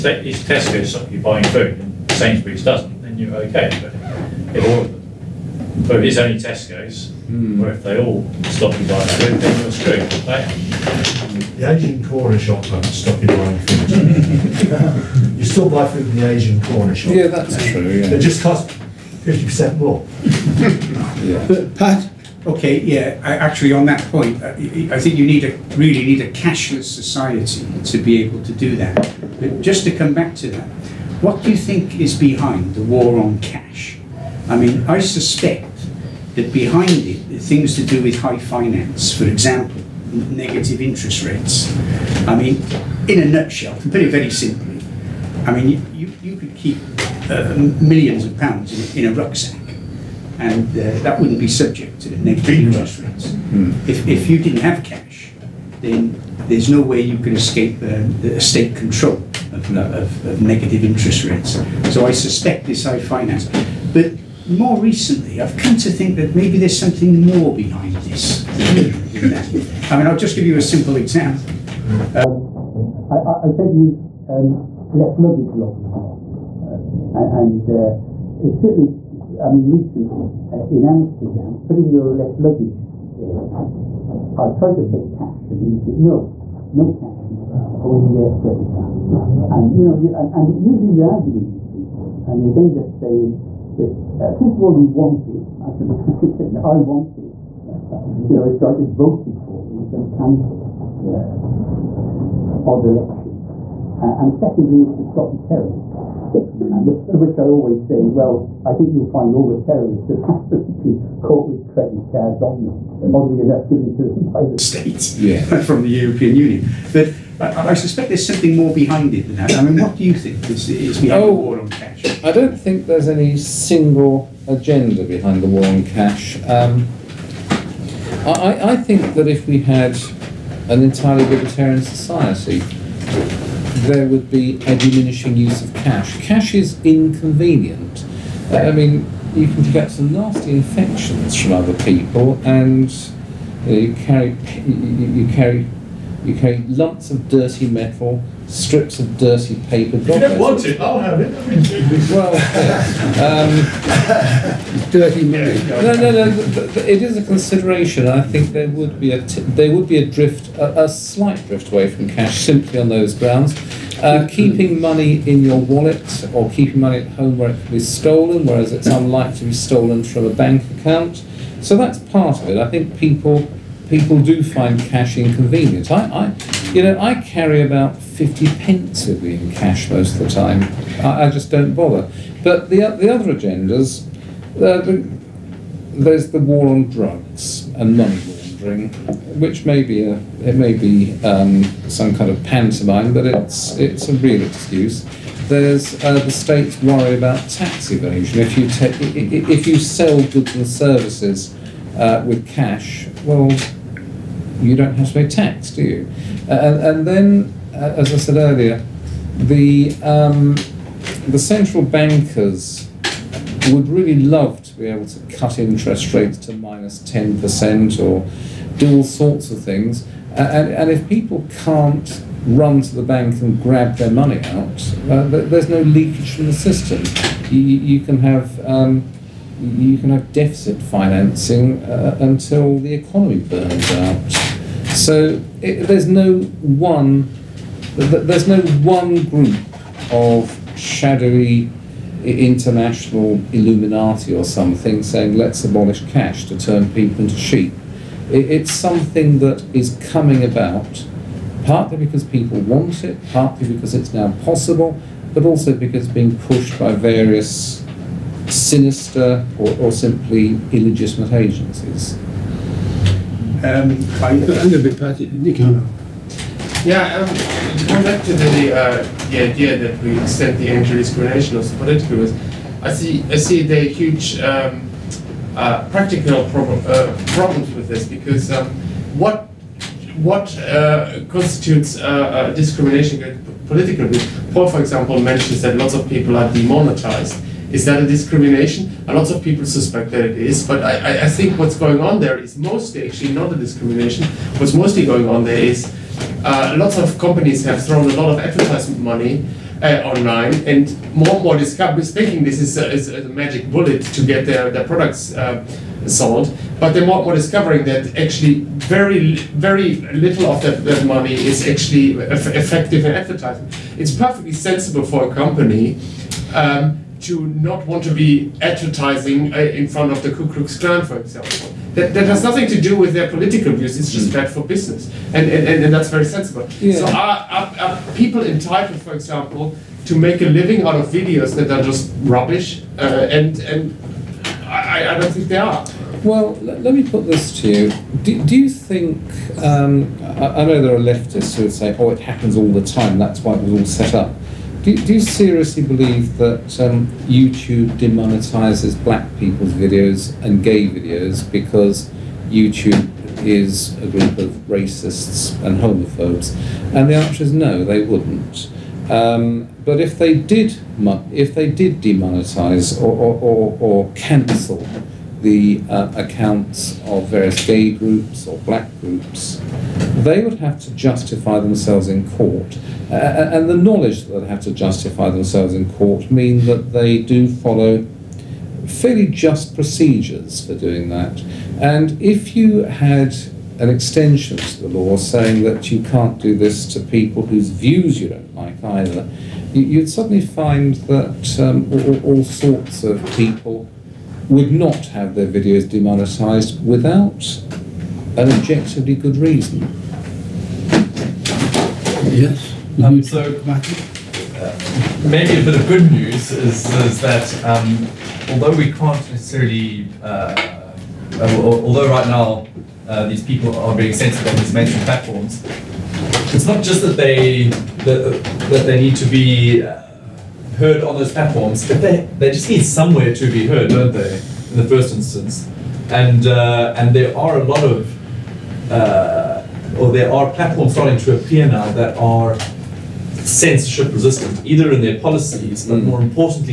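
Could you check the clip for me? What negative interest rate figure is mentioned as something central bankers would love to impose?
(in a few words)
-10%.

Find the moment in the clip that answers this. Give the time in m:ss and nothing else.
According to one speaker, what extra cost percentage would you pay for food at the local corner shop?
0:19.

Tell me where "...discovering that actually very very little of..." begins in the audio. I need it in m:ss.
5:07.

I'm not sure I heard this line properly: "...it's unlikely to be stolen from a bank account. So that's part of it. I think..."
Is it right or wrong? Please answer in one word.
right.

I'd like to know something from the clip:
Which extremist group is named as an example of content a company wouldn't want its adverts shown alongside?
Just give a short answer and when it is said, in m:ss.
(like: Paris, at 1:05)
Ku Klux Klan, at 5:20.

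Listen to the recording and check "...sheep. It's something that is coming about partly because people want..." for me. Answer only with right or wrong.
right.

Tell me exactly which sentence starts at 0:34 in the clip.
I mean, I suspect that behind it are things to do with high finance, for example, negative interest rates.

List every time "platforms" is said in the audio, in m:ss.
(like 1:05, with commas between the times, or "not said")
6:55, 7:01, 7:10.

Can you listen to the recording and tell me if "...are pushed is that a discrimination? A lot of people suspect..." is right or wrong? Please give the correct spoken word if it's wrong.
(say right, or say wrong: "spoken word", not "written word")
wrong: "demonetized", not "pushed".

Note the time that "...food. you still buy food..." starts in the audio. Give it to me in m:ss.
0:13.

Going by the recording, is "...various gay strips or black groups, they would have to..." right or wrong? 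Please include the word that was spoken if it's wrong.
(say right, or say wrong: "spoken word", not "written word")
wrong: "groups", not "strips".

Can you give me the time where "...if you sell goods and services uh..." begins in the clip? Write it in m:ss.
3:19.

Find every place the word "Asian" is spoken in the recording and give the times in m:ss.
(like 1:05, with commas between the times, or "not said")
0:11, 0:16.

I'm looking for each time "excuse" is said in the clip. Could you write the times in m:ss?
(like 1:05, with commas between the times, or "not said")
3:14.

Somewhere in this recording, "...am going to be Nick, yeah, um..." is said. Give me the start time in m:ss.
4:24.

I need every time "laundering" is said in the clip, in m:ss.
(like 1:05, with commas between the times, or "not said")
3:08.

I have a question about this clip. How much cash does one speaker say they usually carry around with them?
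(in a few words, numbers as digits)
50 pence.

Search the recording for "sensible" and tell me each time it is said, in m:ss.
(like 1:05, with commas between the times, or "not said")
5:14, 5:26.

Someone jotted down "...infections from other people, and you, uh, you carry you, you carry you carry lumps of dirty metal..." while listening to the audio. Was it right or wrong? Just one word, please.
right.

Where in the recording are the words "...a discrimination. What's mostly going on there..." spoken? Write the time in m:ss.
4:53.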